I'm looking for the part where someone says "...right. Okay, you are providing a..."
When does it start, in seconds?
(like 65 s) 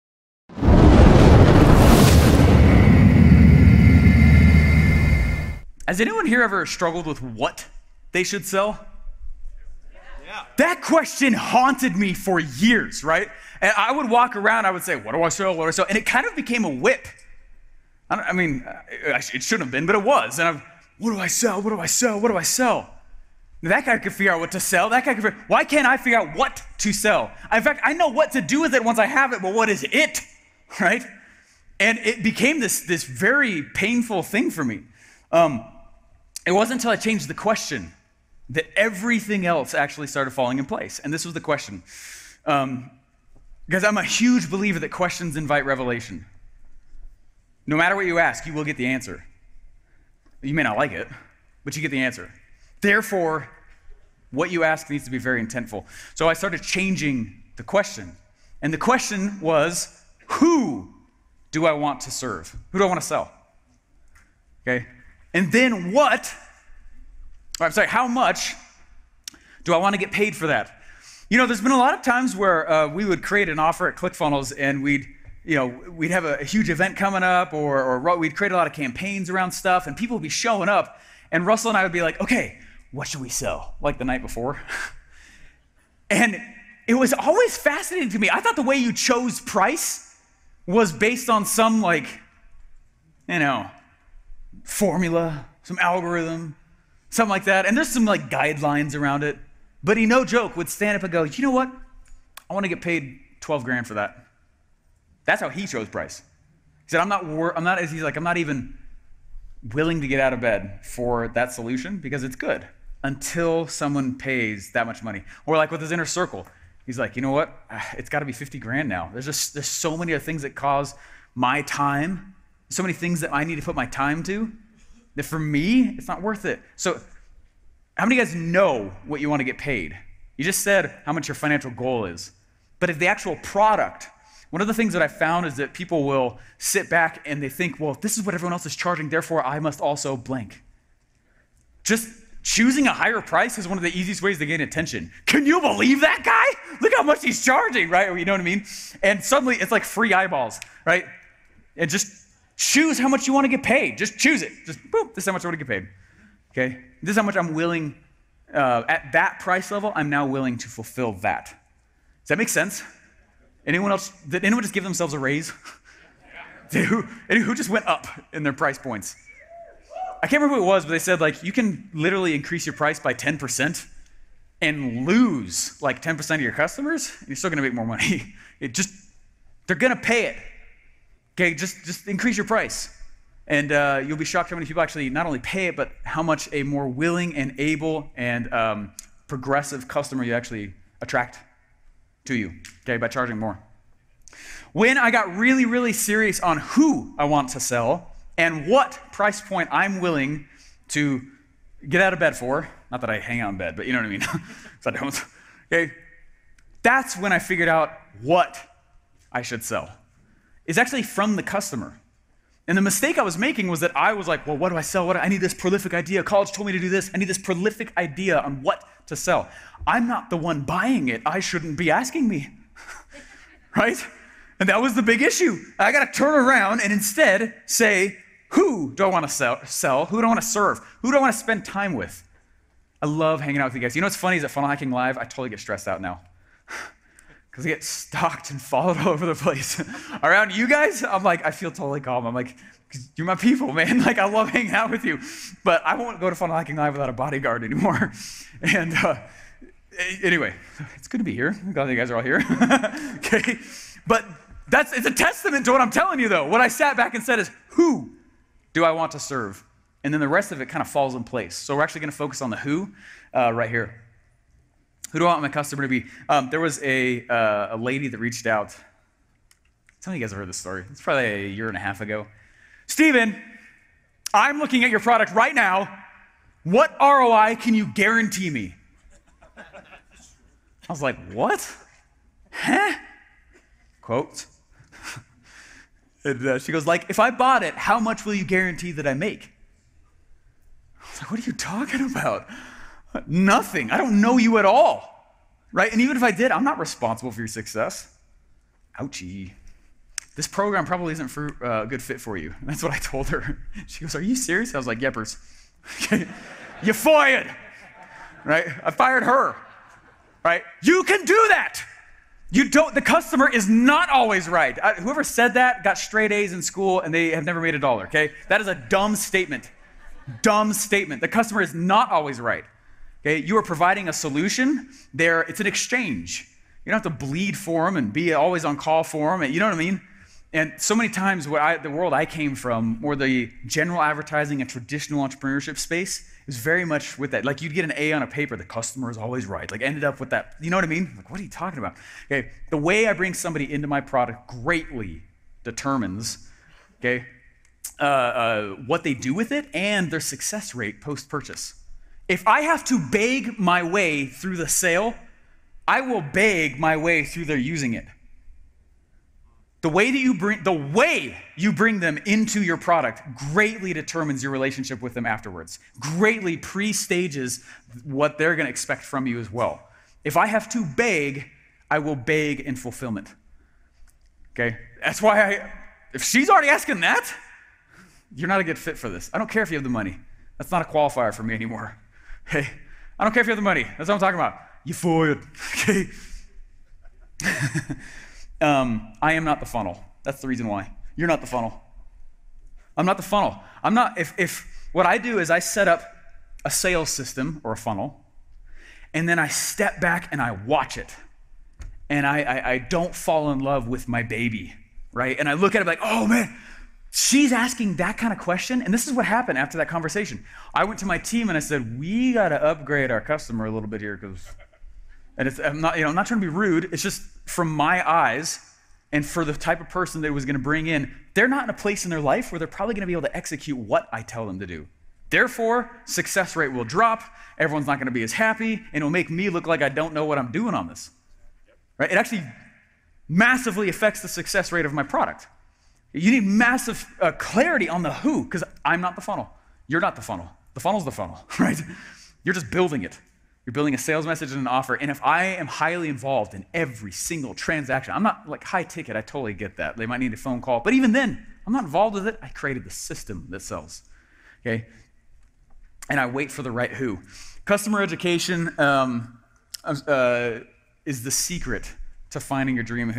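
322 s.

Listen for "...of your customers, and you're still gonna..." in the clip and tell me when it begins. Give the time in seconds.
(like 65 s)
176 s.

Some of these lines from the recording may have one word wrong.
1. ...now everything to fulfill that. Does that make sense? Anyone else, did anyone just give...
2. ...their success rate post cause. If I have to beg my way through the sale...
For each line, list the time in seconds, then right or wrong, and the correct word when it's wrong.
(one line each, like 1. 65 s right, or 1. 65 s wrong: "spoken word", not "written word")
1. 160 s wrong: "willing", not "everything"
2. 350 s wrong: "purchase", not "cause".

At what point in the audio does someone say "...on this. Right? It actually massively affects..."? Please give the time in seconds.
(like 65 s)
430 s.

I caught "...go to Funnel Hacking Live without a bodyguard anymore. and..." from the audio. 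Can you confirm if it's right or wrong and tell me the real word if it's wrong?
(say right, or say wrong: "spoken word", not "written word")
right.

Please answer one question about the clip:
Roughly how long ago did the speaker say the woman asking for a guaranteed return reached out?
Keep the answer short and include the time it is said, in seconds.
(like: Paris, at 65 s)
A year and a half, at 271 s.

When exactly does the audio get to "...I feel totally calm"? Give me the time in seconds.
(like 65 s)
241 s.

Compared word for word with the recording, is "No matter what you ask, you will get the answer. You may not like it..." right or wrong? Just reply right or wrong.
right.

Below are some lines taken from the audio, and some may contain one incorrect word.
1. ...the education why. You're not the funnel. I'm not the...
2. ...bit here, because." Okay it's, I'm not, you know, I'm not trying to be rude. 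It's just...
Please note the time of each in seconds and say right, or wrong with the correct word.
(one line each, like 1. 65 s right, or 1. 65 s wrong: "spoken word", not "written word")
1. 390 s wrong: "reason", not "education"
2. 413 s wrong: "And", not "Okay".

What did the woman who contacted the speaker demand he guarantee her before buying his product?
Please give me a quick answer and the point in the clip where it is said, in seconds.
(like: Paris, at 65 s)
ROI, at 276 s.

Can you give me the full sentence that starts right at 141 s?
Just choosing a higher price is one of the easiest ways to gain attention.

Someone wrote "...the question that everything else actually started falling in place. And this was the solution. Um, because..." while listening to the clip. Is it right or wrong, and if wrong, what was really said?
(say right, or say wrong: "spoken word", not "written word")
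wrong: "question", not "solution".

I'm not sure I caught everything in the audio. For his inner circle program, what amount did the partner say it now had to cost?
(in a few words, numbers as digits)
50 grand.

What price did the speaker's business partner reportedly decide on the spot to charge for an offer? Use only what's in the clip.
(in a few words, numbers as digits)
12 grand.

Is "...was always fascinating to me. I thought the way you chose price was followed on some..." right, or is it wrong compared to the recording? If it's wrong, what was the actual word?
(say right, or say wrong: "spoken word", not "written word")
wrong: "based", not "followed".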